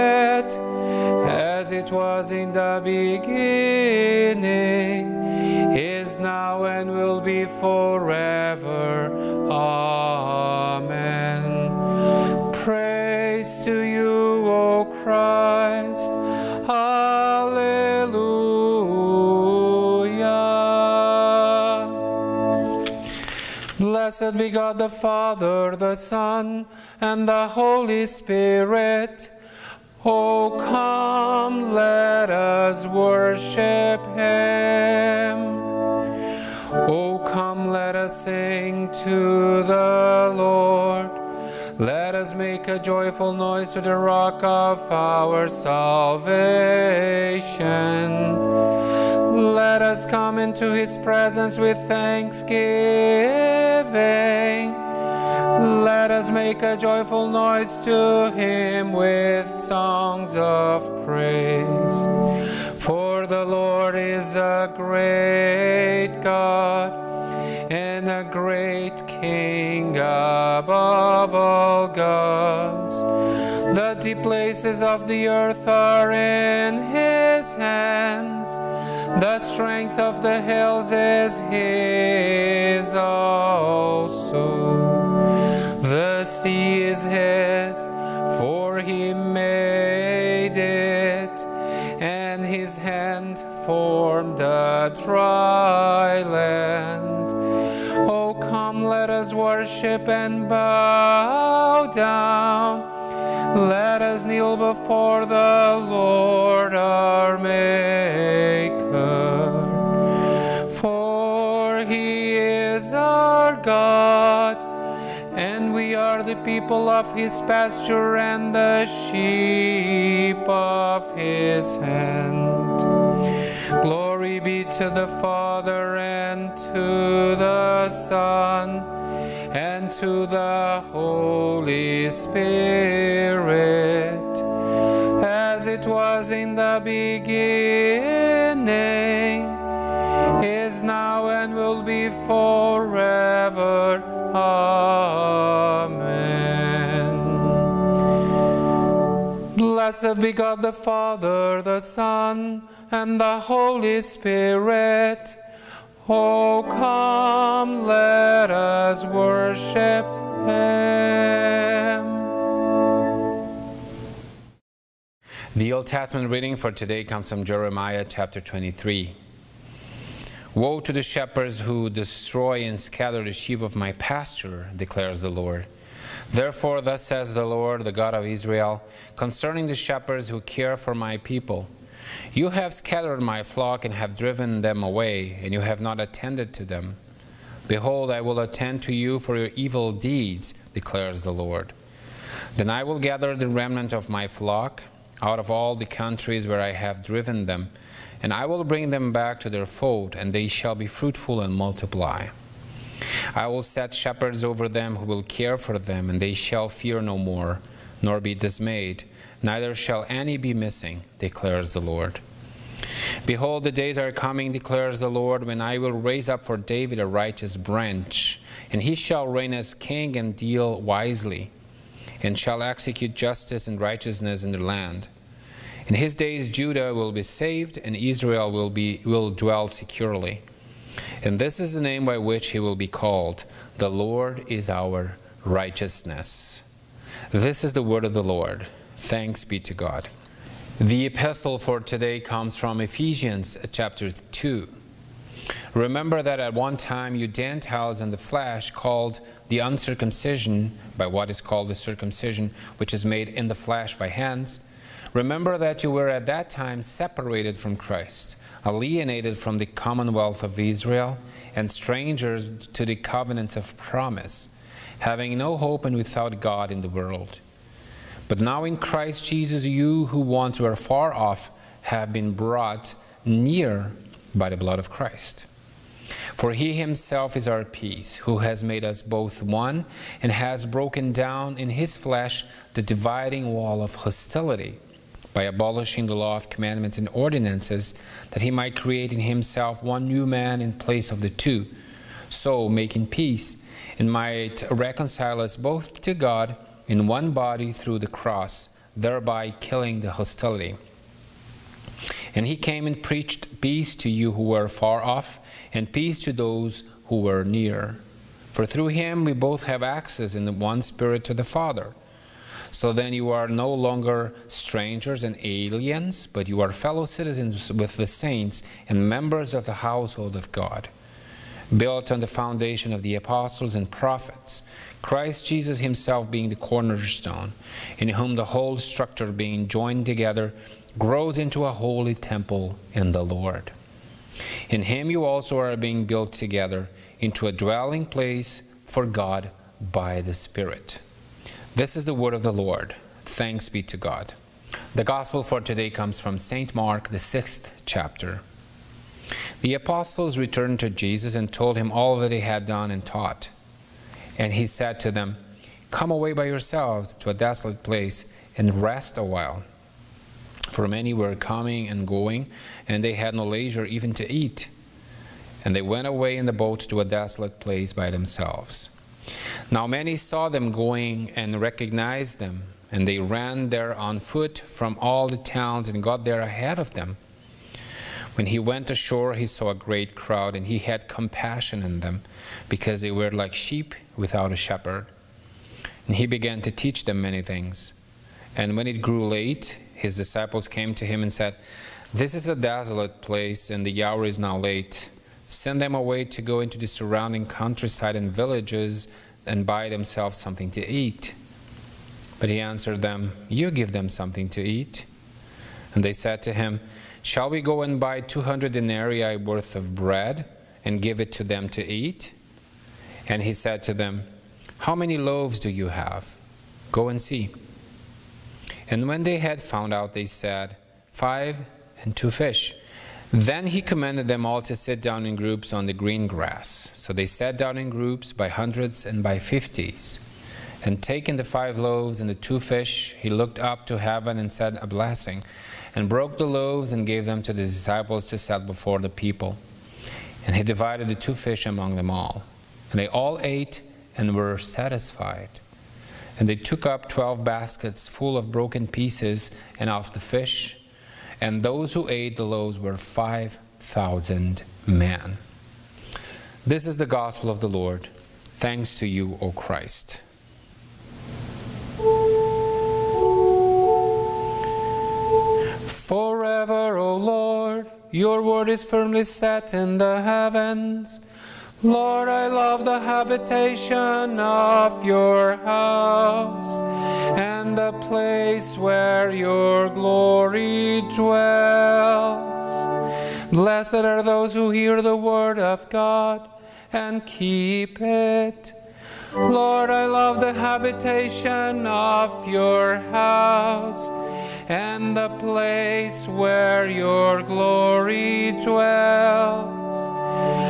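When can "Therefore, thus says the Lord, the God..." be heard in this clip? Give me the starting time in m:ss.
2:56.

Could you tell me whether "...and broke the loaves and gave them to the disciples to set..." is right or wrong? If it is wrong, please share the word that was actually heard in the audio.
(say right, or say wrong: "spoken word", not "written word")
right.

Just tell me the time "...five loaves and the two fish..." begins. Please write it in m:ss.
7:11.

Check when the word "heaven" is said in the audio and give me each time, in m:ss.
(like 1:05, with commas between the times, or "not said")
7:13, 7:50.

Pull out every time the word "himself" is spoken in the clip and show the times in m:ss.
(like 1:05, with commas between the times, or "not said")
4:36, 4:49, 5:25.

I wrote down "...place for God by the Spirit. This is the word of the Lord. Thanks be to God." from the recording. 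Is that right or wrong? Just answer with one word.
right.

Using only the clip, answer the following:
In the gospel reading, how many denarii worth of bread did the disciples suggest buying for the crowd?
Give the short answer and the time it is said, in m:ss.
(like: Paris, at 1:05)
200, at 6:48.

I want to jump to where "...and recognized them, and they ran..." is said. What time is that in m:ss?
6:11.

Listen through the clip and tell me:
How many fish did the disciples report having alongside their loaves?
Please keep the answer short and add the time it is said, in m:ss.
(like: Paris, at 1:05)
2, at 7:01.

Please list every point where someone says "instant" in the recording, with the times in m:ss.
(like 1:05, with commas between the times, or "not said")
not said.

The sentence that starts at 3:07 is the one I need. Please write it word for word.
Behold, I will attend to you for your evil deeds, declares the Lord.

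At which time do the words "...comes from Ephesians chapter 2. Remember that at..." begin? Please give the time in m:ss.
4:02.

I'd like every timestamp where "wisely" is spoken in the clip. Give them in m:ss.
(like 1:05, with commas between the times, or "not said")
3:40.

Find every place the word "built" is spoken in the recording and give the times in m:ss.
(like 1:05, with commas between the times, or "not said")
5:21, 5:36.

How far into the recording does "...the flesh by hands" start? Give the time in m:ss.
4:13.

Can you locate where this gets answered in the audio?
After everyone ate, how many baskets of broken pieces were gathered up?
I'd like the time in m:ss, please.
7:27.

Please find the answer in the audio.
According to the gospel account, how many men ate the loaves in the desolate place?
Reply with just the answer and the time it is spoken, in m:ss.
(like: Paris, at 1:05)
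5,000, at 7:32.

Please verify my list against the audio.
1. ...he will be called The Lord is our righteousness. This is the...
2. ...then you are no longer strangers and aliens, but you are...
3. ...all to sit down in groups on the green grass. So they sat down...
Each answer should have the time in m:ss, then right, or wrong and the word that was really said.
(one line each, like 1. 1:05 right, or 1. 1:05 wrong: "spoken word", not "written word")
1. 3:52 right
2. 5:12 right
3. 7:04 right.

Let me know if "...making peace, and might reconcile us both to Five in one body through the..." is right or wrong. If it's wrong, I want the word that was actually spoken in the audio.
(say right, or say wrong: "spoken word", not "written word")
wrong: "God", not "Five".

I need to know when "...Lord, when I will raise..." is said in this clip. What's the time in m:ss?
3:35.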